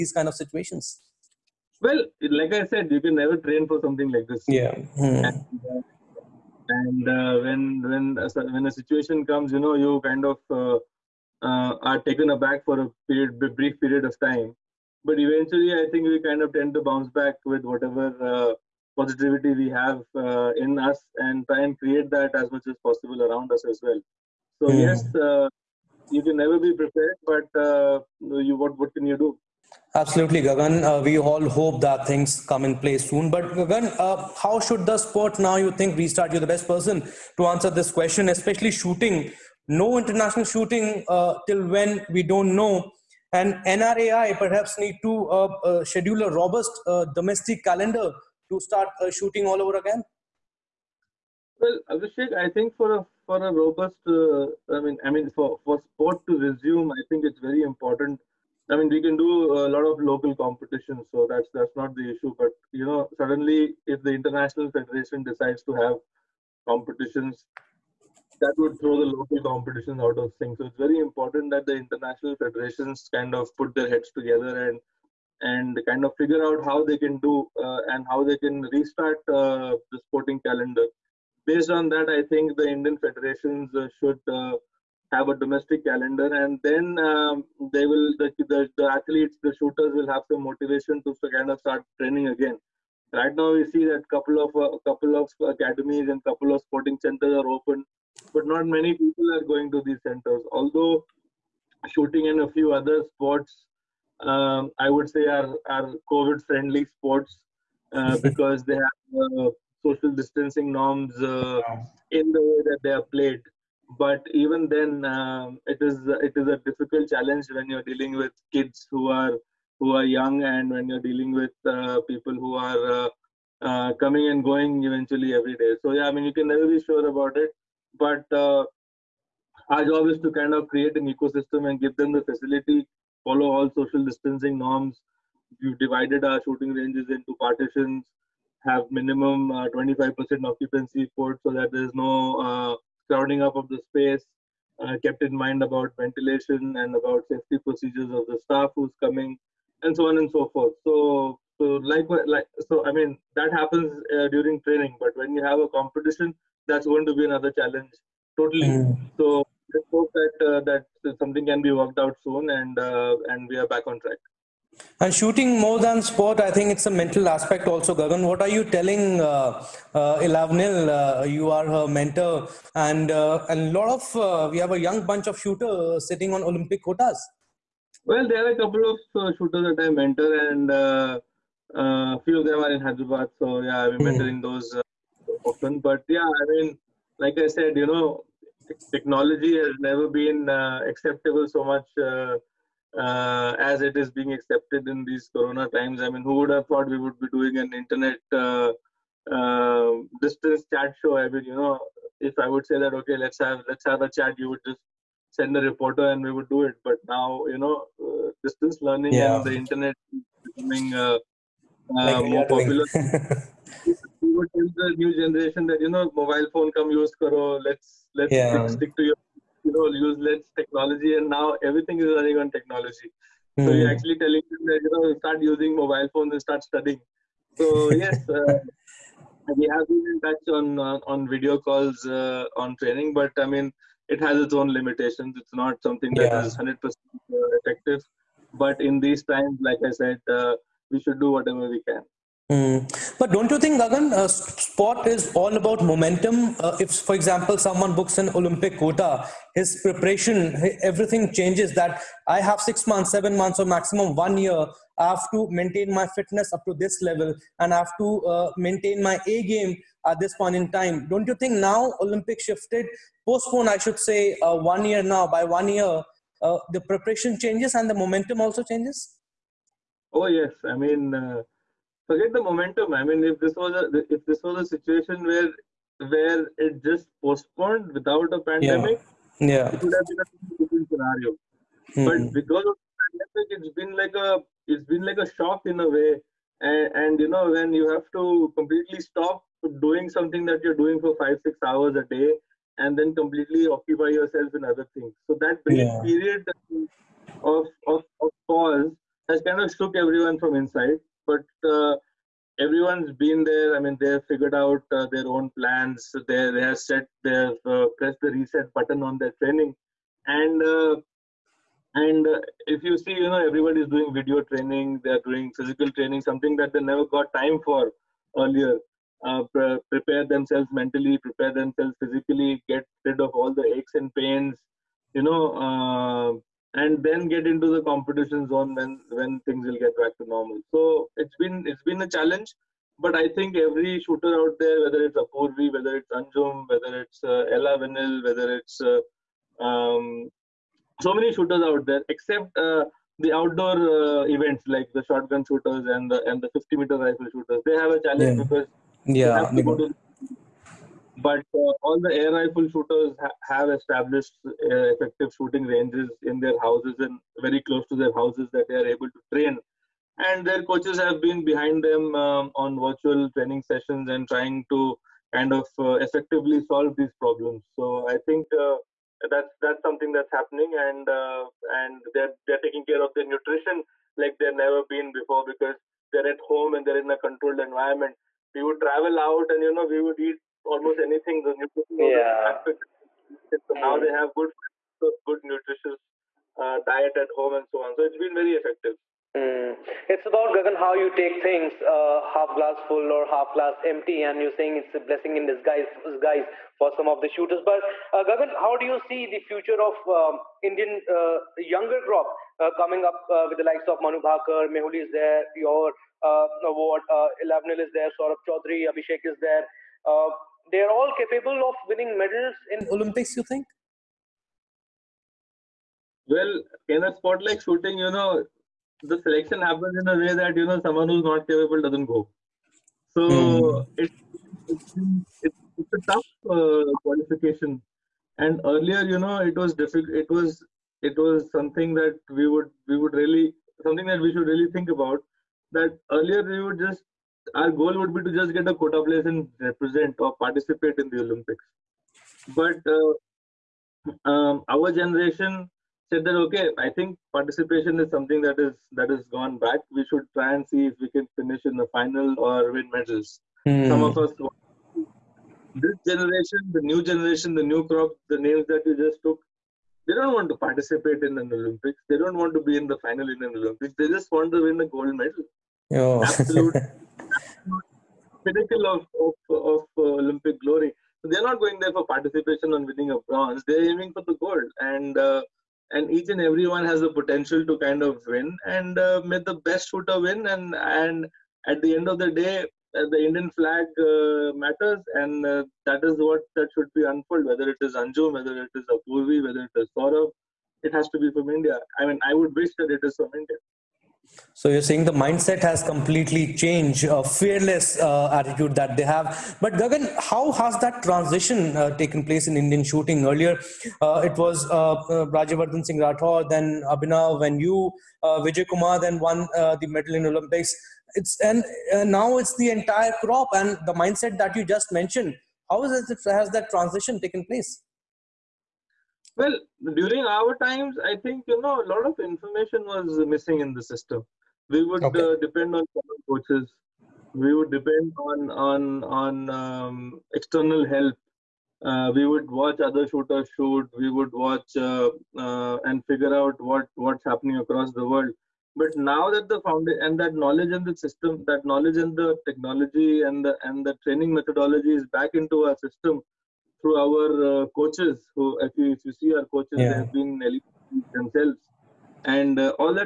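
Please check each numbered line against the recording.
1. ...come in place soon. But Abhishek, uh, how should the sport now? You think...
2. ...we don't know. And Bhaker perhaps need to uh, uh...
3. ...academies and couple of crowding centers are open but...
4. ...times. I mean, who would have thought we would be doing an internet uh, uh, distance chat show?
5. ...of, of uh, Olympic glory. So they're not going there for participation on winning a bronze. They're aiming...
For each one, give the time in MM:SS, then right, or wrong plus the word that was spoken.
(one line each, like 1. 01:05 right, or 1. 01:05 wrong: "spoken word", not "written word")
1. 00:32 wrong: "Gagan", not "Abhishek"
2. 00:42 wrong: "NRAI", not "Bhaker"
3. 01:35 wrong: "sporting", not "crowding"
4. 03:15 right
5. 07:49 right.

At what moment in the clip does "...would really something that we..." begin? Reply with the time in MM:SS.
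07:12.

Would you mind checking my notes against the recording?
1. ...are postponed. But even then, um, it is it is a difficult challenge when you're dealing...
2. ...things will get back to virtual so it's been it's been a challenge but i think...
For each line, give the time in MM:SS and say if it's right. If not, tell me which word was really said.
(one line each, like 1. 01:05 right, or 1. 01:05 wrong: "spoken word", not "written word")
1. 01:52 wrong: "played", not "postponed"
2. 05:29 wrong: "normal", not "virtual".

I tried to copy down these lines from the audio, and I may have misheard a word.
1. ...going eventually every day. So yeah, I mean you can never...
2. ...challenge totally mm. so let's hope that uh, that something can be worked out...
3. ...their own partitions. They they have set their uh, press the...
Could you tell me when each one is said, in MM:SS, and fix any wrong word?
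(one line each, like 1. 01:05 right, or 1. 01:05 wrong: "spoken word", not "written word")
1. 02:04 right
2. 02:37 right
3. 05:05 wrong: "plans", not "partitions".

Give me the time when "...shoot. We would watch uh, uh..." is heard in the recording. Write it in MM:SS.
08:53.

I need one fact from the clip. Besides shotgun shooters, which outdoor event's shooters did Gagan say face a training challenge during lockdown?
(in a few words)
50 meter rifle.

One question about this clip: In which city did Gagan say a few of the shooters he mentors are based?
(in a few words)
Hyderabad.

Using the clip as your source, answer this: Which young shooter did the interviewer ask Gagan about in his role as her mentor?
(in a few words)
Elavenil.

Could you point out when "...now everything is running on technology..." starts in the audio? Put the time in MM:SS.
03:41.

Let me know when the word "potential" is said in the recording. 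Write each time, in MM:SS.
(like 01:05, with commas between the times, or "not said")
07:57.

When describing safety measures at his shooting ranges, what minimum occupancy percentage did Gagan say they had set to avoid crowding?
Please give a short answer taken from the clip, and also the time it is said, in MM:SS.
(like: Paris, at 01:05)
25%, at 02:19.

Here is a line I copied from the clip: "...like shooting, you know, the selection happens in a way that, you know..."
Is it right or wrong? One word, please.
right.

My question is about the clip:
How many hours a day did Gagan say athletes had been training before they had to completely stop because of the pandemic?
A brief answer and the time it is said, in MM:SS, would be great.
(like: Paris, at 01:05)
five six hours, at 04:51.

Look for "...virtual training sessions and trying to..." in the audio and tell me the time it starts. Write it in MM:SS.
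06:02.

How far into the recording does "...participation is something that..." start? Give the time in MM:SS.
07:27.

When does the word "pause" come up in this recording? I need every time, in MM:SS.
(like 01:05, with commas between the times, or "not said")
04:58.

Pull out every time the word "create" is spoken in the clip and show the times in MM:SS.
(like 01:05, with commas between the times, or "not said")
00:21, 02:10.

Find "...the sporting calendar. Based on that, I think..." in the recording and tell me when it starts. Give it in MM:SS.
01:19.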